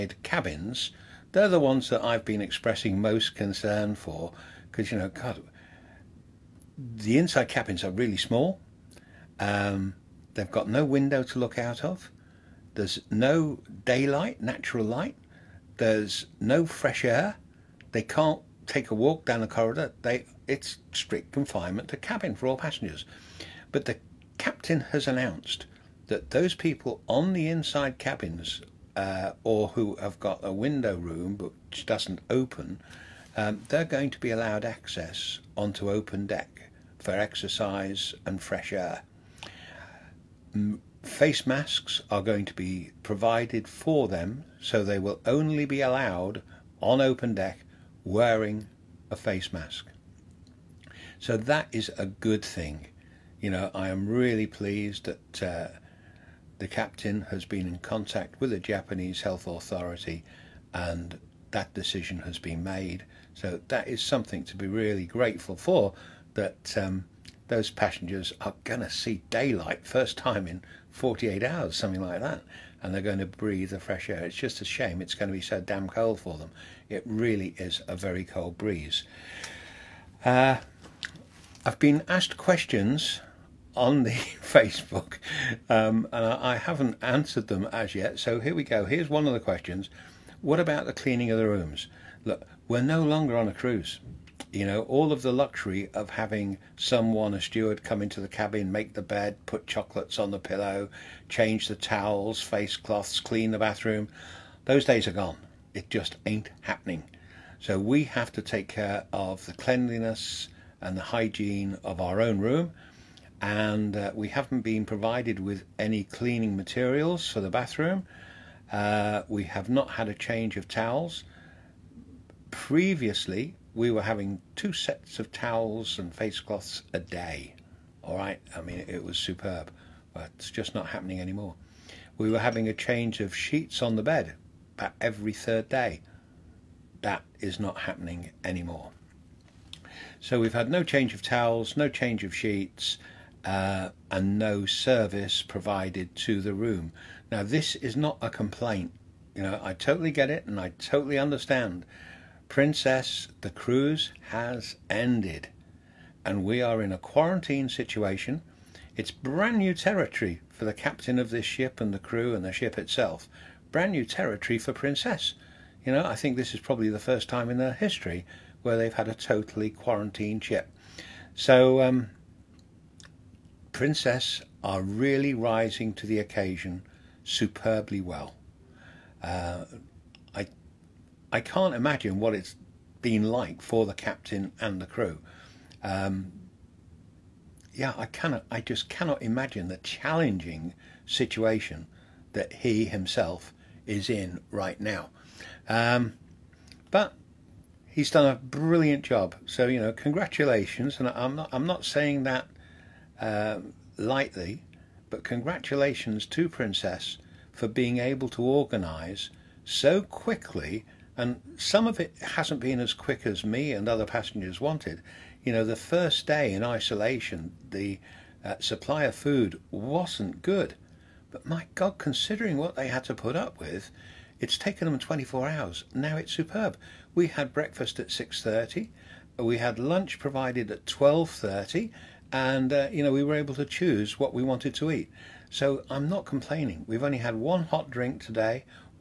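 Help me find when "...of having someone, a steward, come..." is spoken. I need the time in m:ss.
1:35.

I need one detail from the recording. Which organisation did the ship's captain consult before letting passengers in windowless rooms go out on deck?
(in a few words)
Japanese health authority.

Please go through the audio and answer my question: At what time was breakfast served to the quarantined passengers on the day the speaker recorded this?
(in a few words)
6:30.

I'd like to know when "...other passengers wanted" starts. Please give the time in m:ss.
3:33.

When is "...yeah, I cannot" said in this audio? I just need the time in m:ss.
3:07.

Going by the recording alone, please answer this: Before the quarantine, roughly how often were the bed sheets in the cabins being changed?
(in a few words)
Every third day.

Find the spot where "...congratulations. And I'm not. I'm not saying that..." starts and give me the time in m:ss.
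3:19.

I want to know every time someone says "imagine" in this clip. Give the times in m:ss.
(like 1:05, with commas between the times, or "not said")
3:01, 3:09.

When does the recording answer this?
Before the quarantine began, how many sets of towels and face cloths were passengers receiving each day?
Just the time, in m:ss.
2:04.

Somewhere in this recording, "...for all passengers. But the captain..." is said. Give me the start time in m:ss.
0:22.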